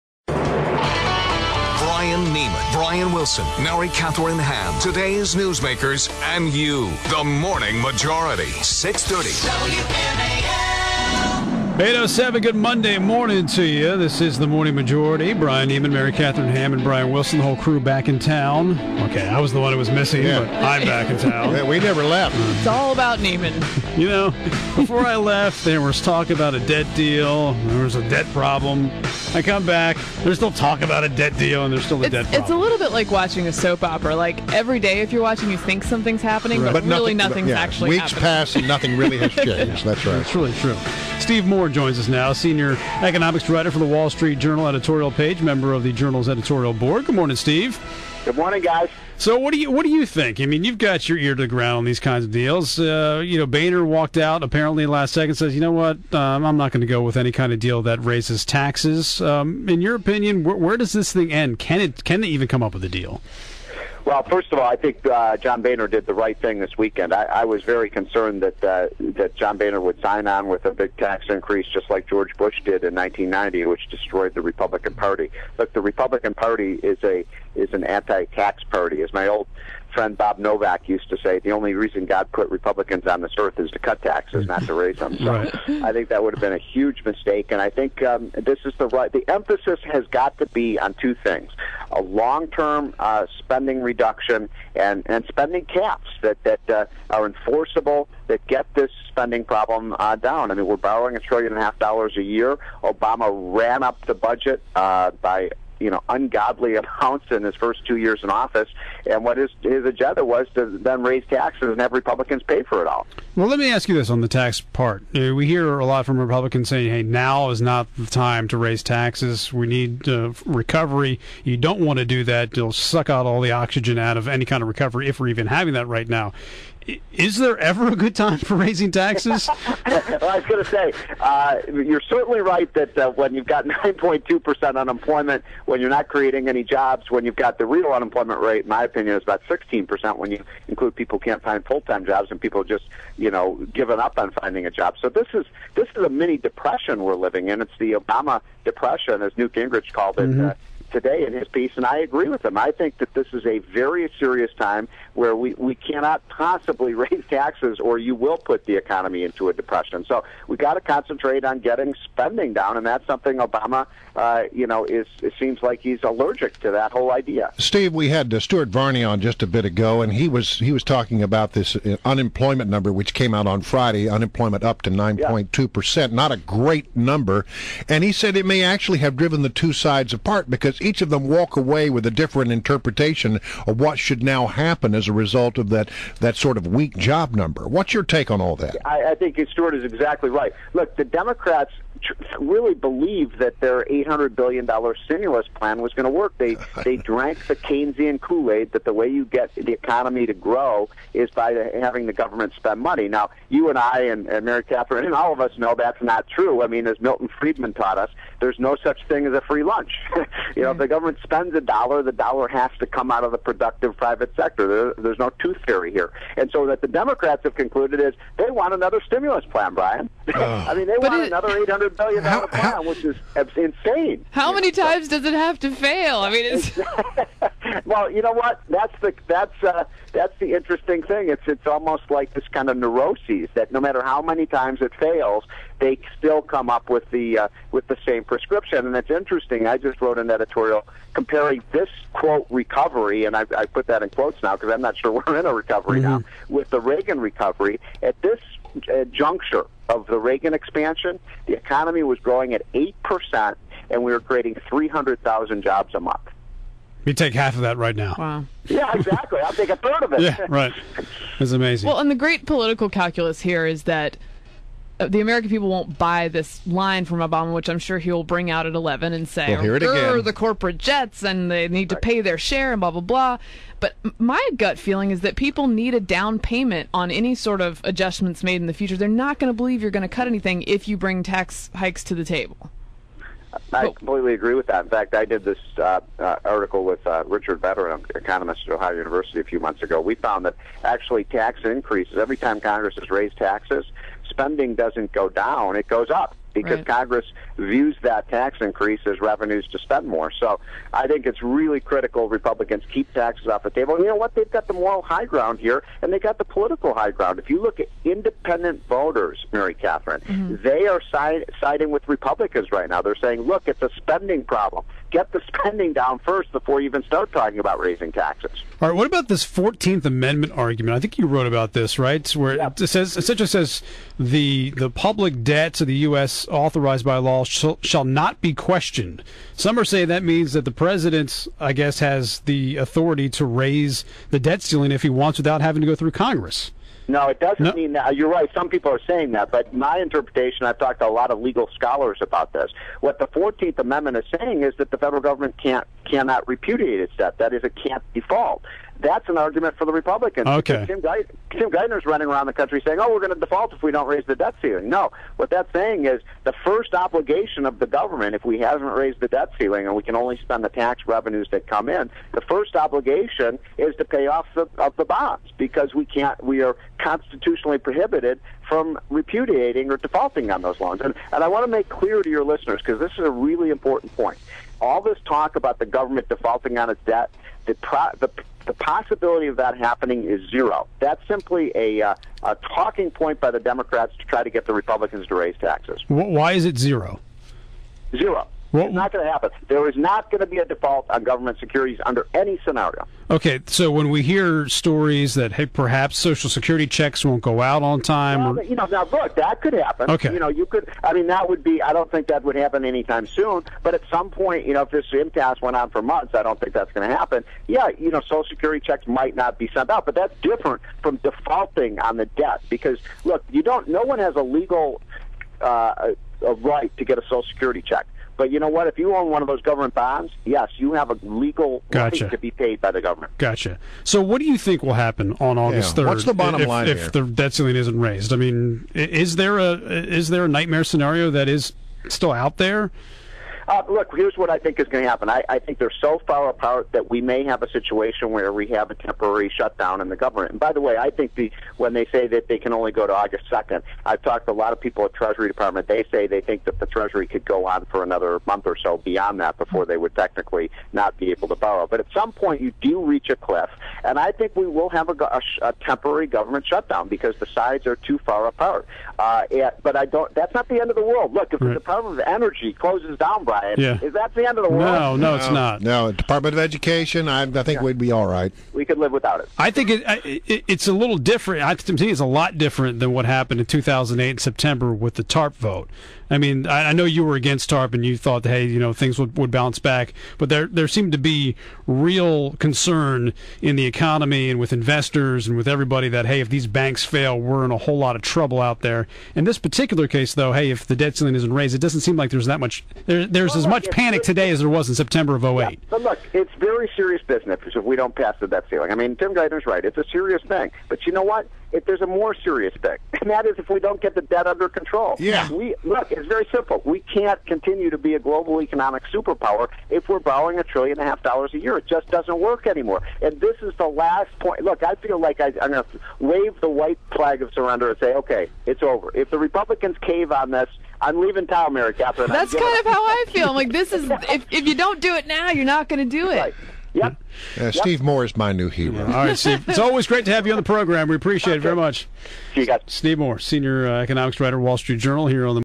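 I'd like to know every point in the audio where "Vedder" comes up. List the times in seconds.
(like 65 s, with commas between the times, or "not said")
287 s.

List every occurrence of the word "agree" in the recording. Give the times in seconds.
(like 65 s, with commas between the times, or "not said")
151 s, 284 s.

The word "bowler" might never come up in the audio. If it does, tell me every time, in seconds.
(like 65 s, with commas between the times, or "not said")
not said.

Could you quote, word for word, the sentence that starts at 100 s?
I mean, we're borrowing a trillion and a half dollars a year.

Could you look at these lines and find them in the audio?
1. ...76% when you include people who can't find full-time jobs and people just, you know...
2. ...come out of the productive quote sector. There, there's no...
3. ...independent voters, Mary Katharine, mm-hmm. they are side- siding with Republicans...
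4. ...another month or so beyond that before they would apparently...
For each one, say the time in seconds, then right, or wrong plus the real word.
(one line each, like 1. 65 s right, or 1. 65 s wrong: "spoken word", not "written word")
1. 139 s wrong: "16", not "76"
2. 212 s wrong: "private", not "quote"
3. 308 s right
4. 448 s wrong: "technically", not "apparently".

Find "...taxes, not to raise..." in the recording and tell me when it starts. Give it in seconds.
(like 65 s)
84 s.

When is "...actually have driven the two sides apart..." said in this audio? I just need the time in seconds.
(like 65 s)
178 s.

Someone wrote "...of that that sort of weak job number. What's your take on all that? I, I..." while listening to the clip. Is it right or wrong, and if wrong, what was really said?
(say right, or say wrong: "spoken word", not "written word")
right.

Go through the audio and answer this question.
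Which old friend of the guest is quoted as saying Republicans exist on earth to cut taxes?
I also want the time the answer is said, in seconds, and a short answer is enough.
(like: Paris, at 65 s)
Bob Novak, at 80 s.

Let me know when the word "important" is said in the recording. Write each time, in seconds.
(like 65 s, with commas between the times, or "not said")
373 s.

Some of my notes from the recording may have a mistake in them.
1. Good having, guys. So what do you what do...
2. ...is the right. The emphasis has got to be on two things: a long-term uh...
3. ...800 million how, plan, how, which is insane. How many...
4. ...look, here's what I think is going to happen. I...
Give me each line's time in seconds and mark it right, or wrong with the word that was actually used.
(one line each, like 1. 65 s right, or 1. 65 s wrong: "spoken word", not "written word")
1. 48 s wrong: "morning", not "having"
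2. 88 s right
3. 221 s right
4. 433 s right.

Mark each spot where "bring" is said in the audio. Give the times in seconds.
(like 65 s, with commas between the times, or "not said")
268 s, 280 s.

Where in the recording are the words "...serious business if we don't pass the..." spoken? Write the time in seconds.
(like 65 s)
496 s.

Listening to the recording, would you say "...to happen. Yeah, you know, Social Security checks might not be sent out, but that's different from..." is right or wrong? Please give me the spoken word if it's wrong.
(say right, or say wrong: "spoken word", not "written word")
right.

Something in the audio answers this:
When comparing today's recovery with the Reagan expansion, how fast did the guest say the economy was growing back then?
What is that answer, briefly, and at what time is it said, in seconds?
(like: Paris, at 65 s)
8%, at 252 s.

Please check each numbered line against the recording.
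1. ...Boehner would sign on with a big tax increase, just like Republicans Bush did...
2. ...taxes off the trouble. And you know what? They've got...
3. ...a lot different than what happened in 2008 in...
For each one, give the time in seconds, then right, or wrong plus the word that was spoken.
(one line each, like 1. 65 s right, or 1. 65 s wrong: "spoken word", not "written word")
1. 69 s wrong: "George", not "Republicans"
2. 303 s wrong: "table", not "trouble"
3. 472 s right.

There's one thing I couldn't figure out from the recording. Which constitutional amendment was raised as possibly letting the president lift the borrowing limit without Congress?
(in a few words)
Fourteenth Amendment.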